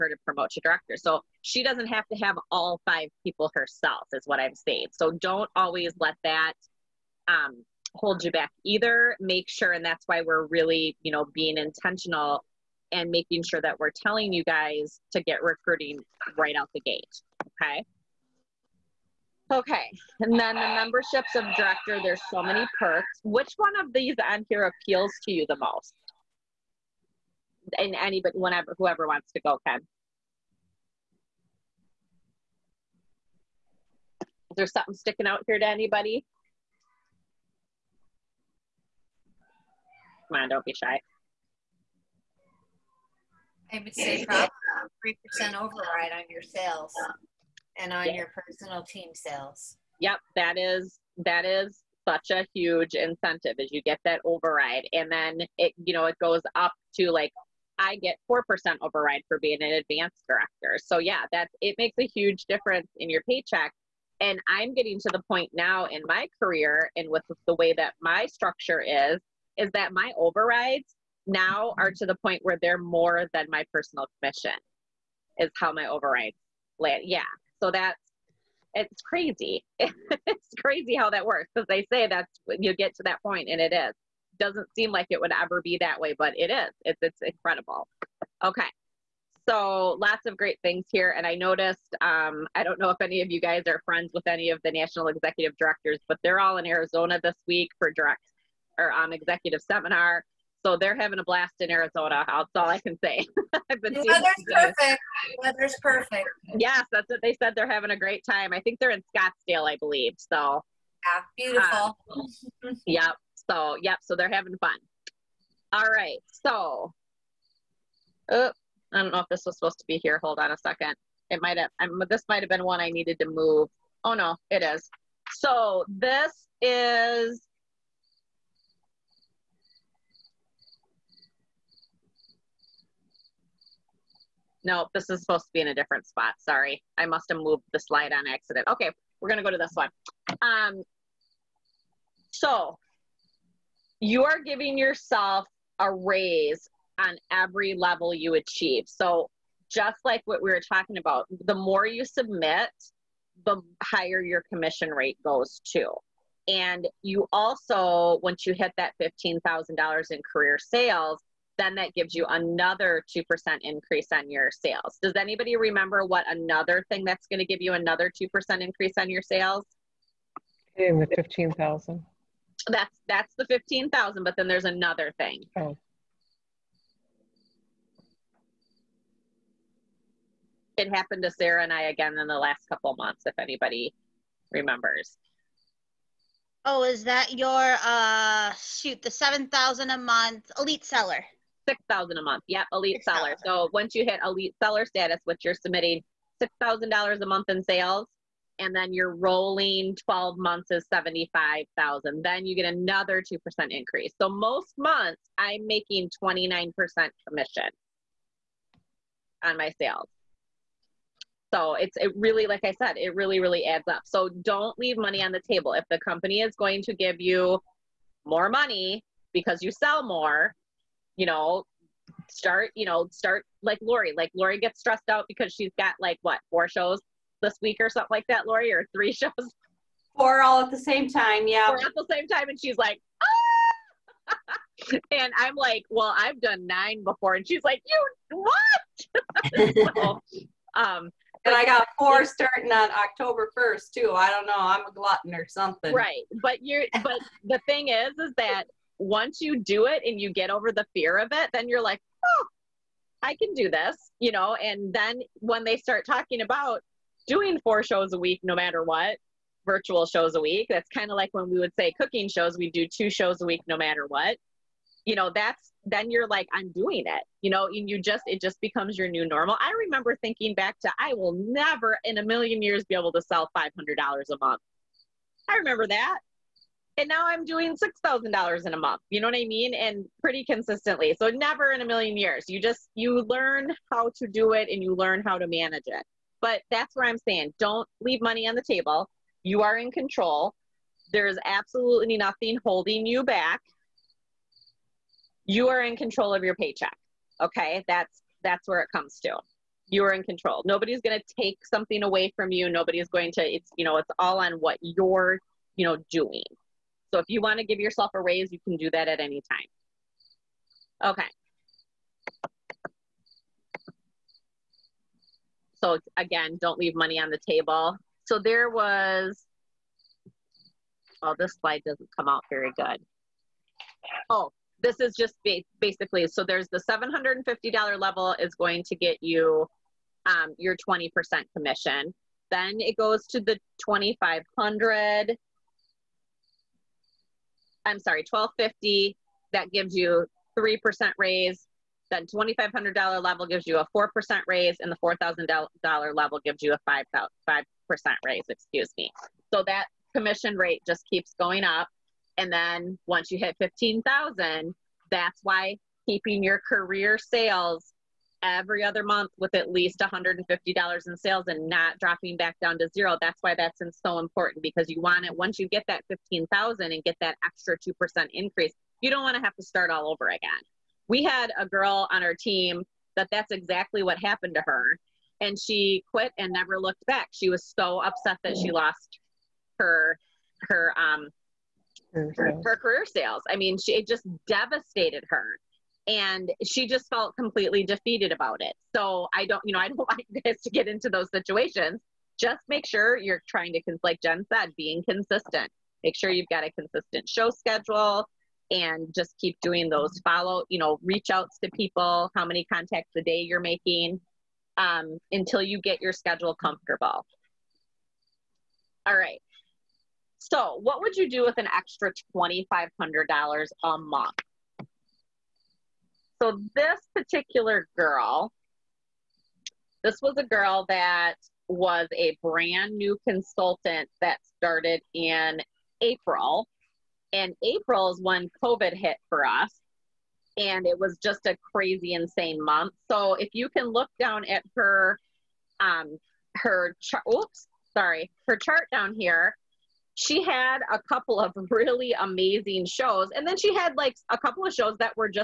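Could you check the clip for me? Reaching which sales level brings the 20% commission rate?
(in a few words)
$750.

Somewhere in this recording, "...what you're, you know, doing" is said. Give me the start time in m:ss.
5:04.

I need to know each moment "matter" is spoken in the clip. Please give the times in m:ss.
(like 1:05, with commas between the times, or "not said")
4:18, 4:23.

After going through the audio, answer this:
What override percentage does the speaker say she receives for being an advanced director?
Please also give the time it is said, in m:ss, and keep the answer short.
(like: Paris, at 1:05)
4%, at 0:58.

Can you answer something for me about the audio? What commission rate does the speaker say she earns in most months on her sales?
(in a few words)
29%.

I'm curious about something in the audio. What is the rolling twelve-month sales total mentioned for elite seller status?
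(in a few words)
75,000.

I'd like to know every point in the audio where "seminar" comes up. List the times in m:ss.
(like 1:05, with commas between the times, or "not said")
1:39.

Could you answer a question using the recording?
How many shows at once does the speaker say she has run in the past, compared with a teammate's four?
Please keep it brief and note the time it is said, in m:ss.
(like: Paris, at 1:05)
9, at 3:56.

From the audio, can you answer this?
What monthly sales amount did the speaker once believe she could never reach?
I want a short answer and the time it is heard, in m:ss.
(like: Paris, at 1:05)
$500, at 4:33.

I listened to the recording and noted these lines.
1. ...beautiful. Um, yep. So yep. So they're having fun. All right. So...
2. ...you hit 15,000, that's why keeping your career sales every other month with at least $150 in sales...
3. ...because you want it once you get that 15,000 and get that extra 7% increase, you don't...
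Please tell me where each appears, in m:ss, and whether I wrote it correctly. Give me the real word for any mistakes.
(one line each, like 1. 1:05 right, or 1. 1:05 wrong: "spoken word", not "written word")
1. 1:51 right
2. 5:53 right
3. 6:04 wrong: "2", not "7".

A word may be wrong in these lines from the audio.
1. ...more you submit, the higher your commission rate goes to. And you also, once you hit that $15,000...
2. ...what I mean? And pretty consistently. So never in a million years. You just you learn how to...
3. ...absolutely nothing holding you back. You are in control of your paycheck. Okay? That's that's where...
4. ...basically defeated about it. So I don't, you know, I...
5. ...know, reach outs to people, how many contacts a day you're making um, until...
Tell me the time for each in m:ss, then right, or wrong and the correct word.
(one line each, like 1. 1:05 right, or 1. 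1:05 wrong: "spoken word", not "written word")
1. 2:31 right
2. 4:39 right
3. 4:51 right
4. 6:27 wrong: "completely", not "basically"
5. 6:40 right.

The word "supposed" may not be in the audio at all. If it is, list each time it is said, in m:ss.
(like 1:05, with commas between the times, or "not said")
1:59, 2:15.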